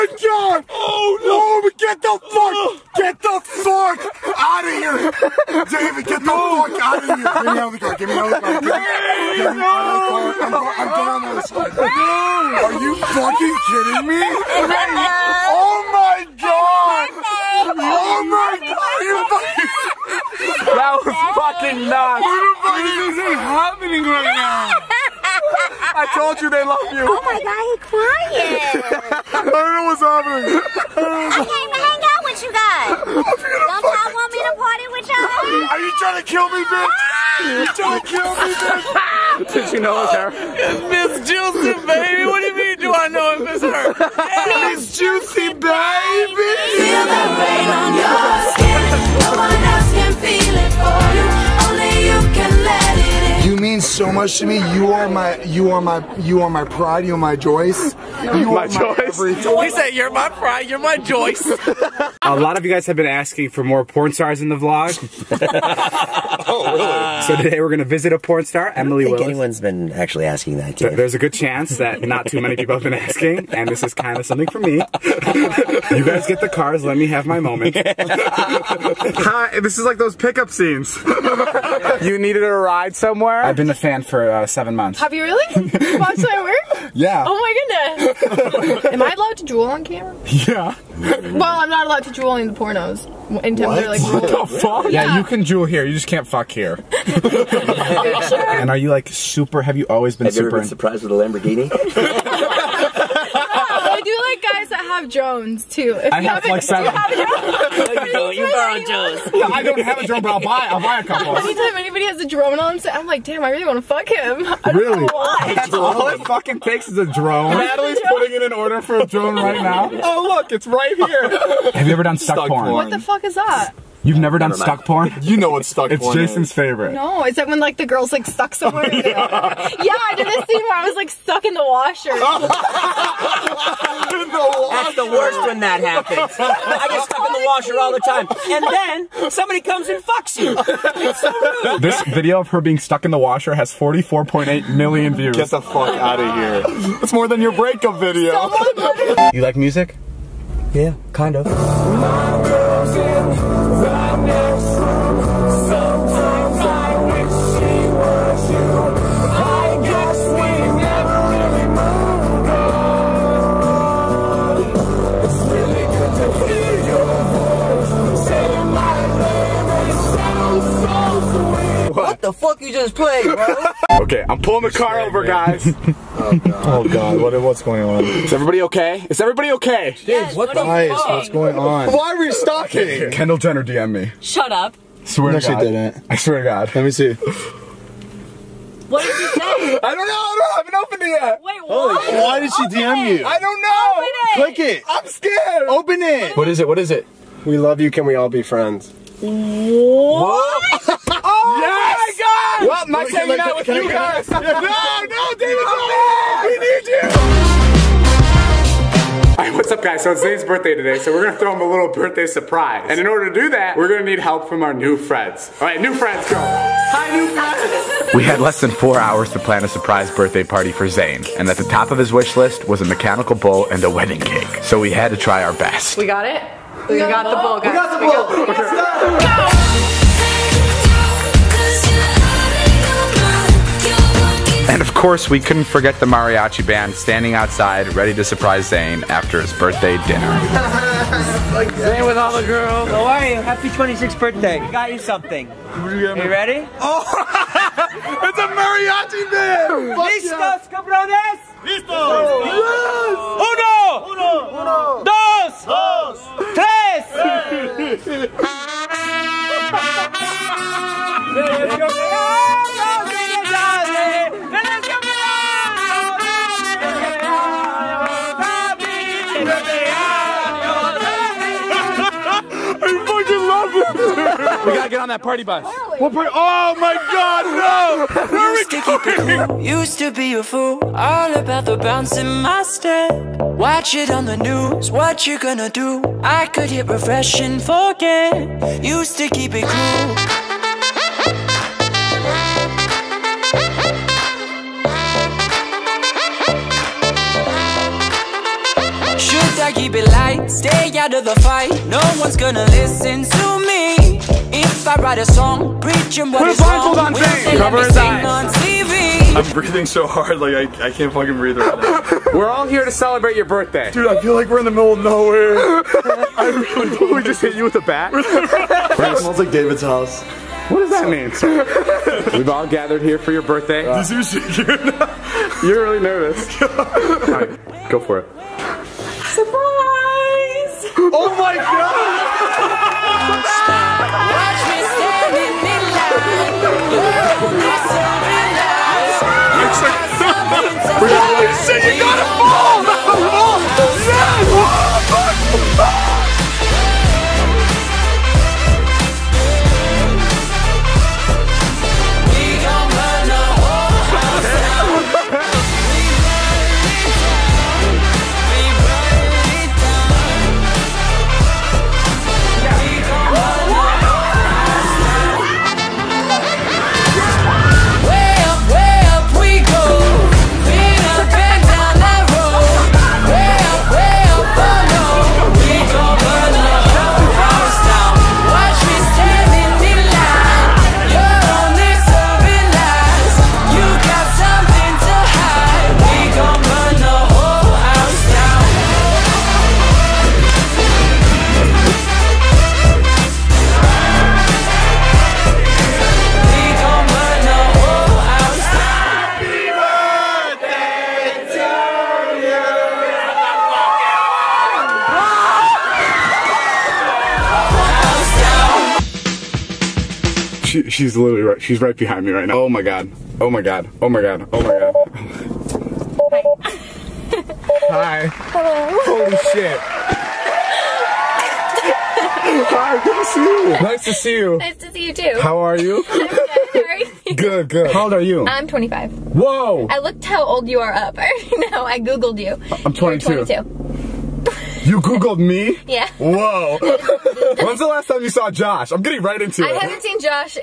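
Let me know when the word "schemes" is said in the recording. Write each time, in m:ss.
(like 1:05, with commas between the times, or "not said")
not said.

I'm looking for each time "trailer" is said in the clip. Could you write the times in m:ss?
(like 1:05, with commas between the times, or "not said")
not said.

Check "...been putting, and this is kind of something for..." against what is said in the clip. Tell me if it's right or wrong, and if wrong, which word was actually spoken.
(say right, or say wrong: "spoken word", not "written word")
wrong: "asking", not "putting".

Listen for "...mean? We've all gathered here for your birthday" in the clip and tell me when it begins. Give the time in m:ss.
5:21.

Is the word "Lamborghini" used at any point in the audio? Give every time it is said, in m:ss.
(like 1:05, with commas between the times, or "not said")
1:41.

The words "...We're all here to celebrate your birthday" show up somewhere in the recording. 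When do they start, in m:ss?
5:12.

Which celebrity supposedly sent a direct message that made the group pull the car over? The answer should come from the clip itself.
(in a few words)
Kendall Jenner.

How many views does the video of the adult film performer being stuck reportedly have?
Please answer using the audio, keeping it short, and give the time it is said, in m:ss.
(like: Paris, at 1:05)
44.8 million, at 2:23.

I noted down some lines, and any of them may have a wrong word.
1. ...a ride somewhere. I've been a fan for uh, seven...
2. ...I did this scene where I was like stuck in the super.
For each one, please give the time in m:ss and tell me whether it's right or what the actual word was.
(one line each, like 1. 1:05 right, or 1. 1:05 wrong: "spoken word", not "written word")
1. 1:22 right
2. 2:09 wrong: "washer", not "super".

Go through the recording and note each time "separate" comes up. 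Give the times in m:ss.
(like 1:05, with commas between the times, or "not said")
not said.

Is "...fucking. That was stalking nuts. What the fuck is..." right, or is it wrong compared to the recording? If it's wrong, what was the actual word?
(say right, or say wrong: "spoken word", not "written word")
wrong: "fucking", not "stalking".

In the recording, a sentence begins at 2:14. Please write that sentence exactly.
That's the worst when that happens.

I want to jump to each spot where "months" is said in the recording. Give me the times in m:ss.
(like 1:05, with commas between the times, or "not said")
1:24.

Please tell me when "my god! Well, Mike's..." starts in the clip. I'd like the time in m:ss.
3:22.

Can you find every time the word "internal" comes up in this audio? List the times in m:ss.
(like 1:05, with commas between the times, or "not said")
not said.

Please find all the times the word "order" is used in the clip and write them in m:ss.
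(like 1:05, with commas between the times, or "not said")
1:58, 3:33.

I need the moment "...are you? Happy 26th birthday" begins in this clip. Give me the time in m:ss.
4:03.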